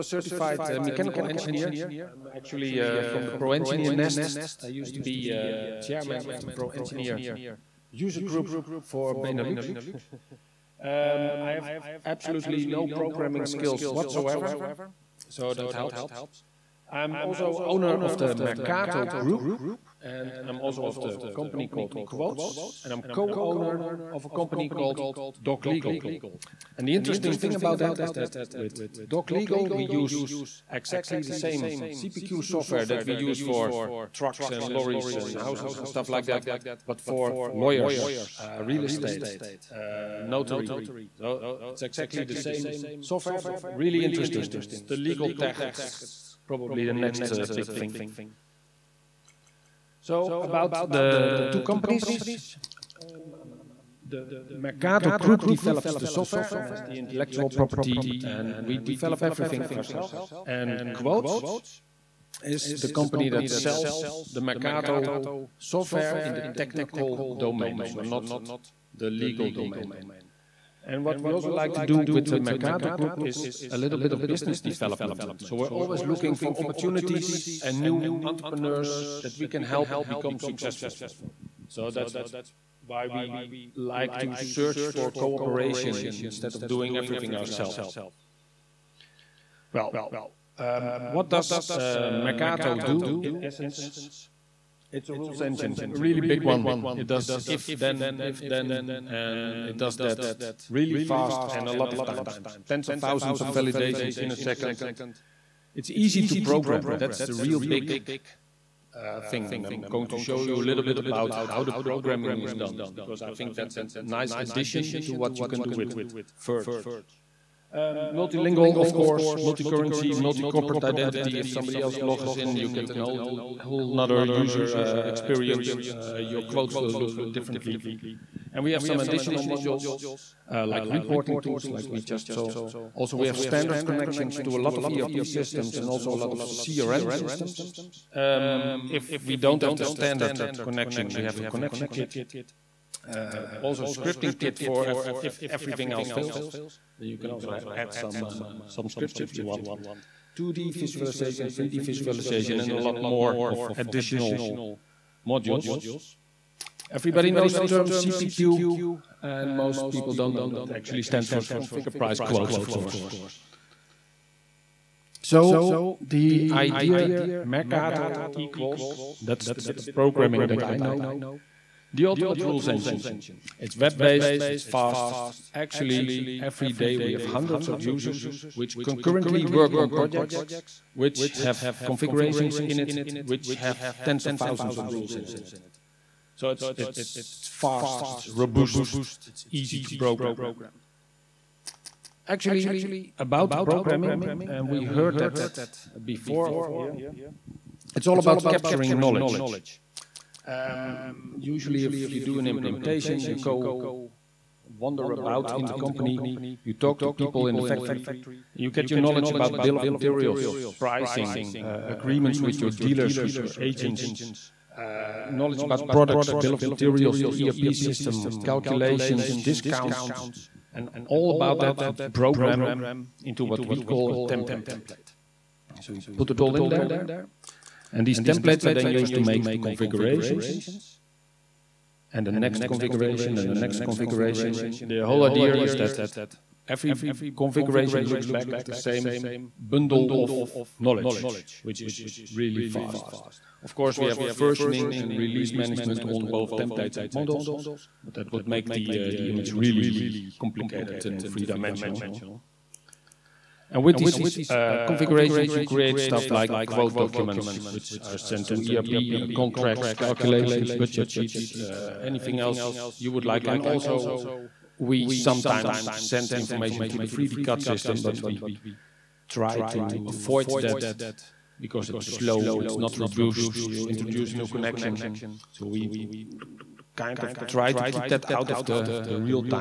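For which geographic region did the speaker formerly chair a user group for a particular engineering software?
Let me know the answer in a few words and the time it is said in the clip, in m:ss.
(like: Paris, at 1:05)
Benelux, at 0:09.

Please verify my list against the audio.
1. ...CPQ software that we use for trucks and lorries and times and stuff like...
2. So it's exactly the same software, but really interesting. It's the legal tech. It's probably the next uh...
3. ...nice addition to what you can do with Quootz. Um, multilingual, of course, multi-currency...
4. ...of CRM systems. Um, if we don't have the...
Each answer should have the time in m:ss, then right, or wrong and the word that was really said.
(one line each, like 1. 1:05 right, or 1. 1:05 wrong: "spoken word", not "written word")
1. 0:31 wrong: "houses", not "times"
2. 0:41 right
3. 1:54 wrong: "Verge", not "Quootz"
4. 2:16 right.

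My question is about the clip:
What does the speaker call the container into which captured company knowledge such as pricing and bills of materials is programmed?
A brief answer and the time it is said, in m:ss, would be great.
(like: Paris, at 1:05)
template, at 3:44.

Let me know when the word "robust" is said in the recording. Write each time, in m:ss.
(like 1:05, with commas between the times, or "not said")
3:08, 4:32.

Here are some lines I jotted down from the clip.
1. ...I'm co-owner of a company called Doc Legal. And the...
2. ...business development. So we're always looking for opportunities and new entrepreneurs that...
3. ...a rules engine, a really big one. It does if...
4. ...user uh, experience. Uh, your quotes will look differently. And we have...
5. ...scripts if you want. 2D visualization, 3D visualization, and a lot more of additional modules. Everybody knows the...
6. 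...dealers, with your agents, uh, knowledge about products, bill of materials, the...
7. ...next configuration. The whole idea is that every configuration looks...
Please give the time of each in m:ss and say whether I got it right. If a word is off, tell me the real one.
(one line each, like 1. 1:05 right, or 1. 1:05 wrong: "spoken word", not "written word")
1. 0:22 right
2. 1:14 right
3. 1:35 right
4. 2:04 right
5. 2:28 right
6. 3:32 right
7. 3:53 right.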